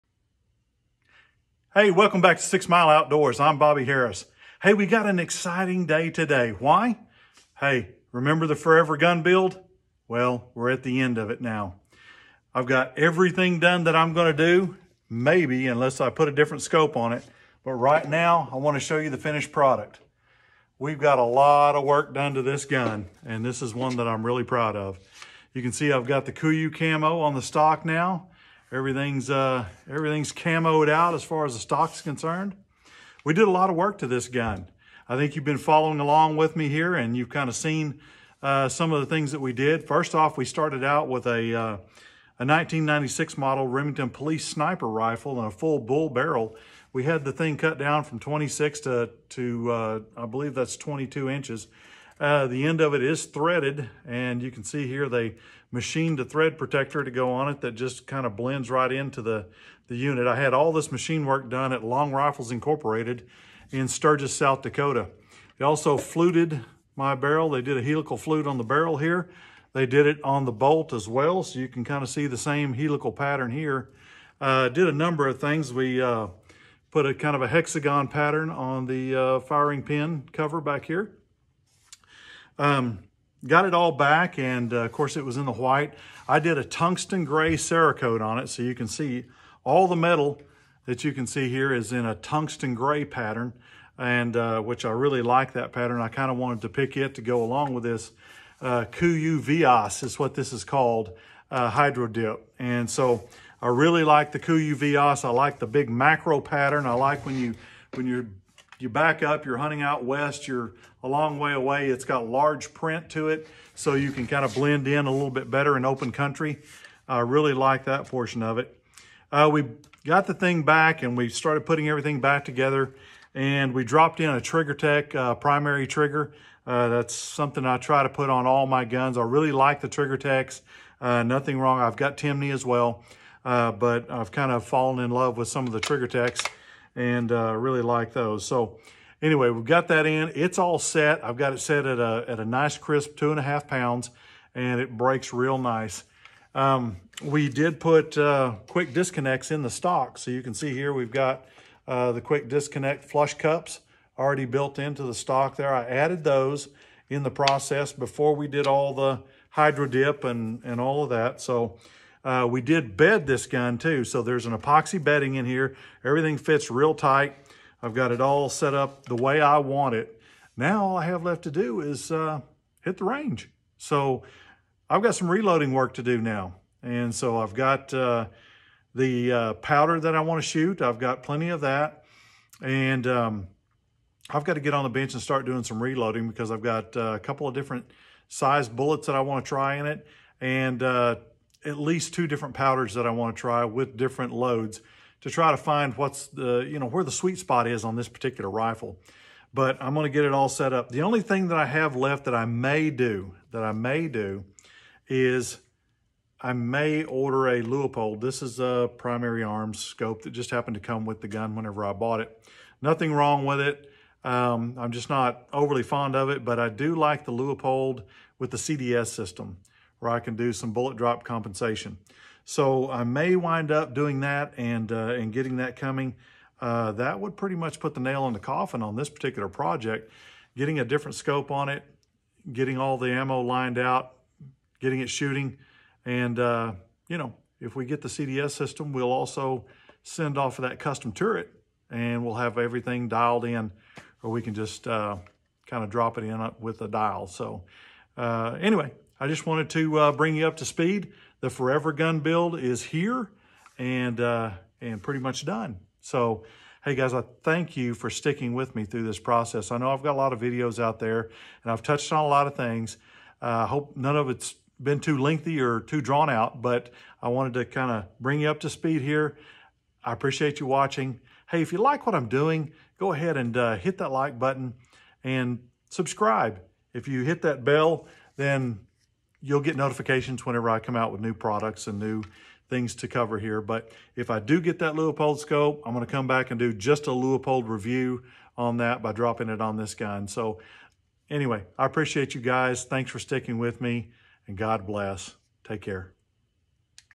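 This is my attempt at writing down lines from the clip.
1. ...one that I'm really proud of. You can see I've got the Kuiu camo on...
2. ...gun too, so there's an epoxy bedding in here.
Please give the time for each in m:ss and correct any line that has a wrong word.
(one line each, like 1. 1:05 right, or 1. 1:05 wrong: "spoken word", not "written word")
1. 0:23 right
2. 2:43 right.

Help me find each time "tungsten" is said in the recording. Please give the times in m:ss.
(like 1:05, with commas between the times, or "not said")
1:26, 1:32.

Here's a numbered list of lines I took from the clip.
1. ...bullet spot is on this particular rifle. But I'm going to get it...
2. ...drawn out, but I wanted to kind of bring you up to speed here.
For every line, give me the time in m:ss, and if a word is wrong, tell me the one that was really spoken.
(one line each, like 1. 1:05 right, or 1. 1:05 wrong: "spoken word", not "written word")
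1. 3:17 wrong: "sweet", not "bullet"
2. 4:26 right.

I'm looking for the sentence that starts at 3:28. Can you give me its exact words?
This is a primary arms scope that just happened to come with the gun whenever I bought it.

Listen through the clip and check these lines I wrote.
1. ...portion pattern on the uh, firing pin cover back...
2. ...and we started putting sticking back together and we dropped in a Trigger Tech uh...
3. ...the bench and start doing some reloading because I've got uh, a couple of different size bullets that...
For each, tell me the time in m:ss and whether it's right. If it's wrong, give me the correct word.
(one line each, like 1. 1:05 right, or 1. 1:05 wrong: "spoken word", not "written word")
1. 1:17 wrong: "hexagon", not "portion"
2. 2:01 wrong: "everything", not "sticking"
3. 3:04 right.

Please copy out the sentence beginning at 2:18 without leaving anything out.
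So anyway, we've got that in.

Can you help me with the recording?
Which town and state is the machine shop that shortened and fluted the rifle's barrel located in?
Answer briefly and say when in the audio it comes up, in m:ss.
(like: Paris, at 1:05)
Sturgis, South Dakota, at 1:03.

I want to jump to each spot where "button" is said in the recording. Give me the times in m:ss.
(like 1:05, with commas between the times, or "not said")
4:34.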